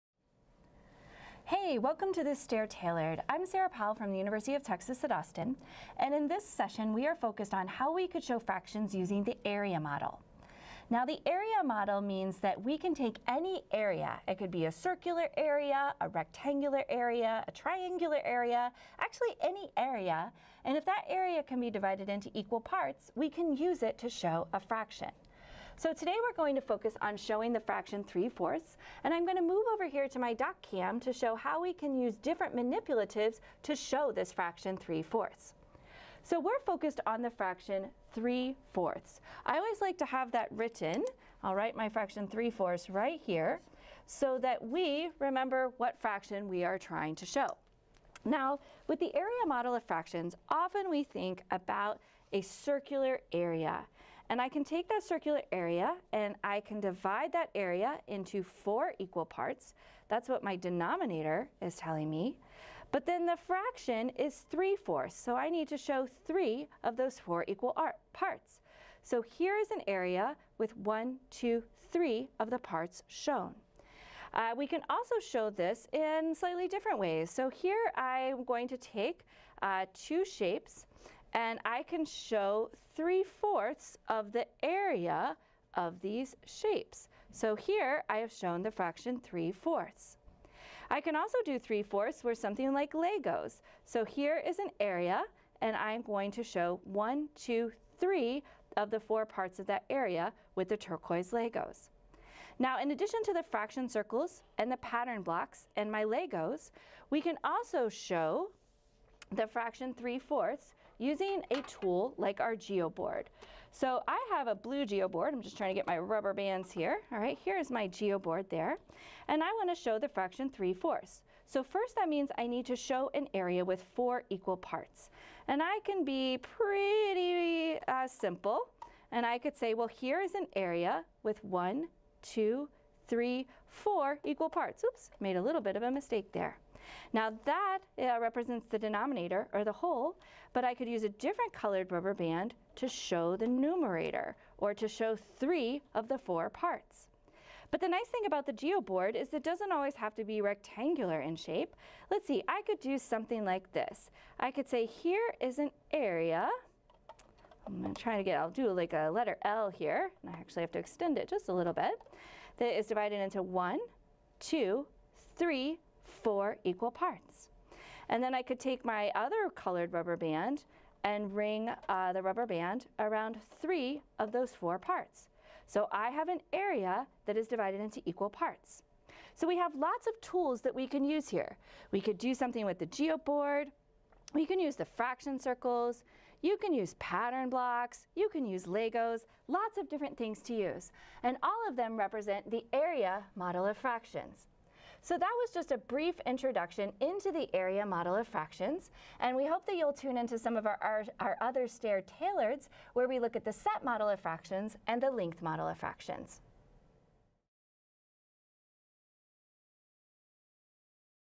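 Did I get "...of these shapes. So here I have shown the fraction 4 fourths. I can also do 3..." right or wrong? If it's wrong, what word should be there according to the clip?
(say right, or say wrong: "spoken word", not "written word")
wrong: "3", not "4".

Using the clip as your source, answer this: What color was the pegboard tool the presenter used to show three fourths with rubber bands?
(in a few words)
Blue.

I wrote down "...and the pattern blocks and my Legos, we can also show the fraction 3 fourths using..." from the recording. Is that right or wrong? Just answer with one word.
right.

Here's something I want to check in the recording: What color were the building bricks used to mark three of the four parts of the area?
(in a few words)
Turquoise.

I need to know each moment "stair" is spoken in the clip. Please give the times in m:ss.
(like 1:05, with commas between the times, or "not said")
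0:02, 3:21.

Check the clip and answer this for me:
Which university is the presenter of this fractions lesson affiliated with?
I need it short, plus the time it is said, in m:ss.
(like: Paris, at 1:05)
University of Texas at Austin, at 0:04.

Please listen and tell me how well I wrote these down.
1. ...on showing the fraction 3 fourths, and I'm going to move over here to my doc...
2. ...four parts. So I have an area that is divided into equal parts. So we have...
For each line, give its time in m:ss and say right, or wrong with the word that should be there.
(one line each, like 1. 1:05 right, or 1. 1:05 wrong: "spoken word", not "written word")
1. 0:27 right
2. 2:54 right.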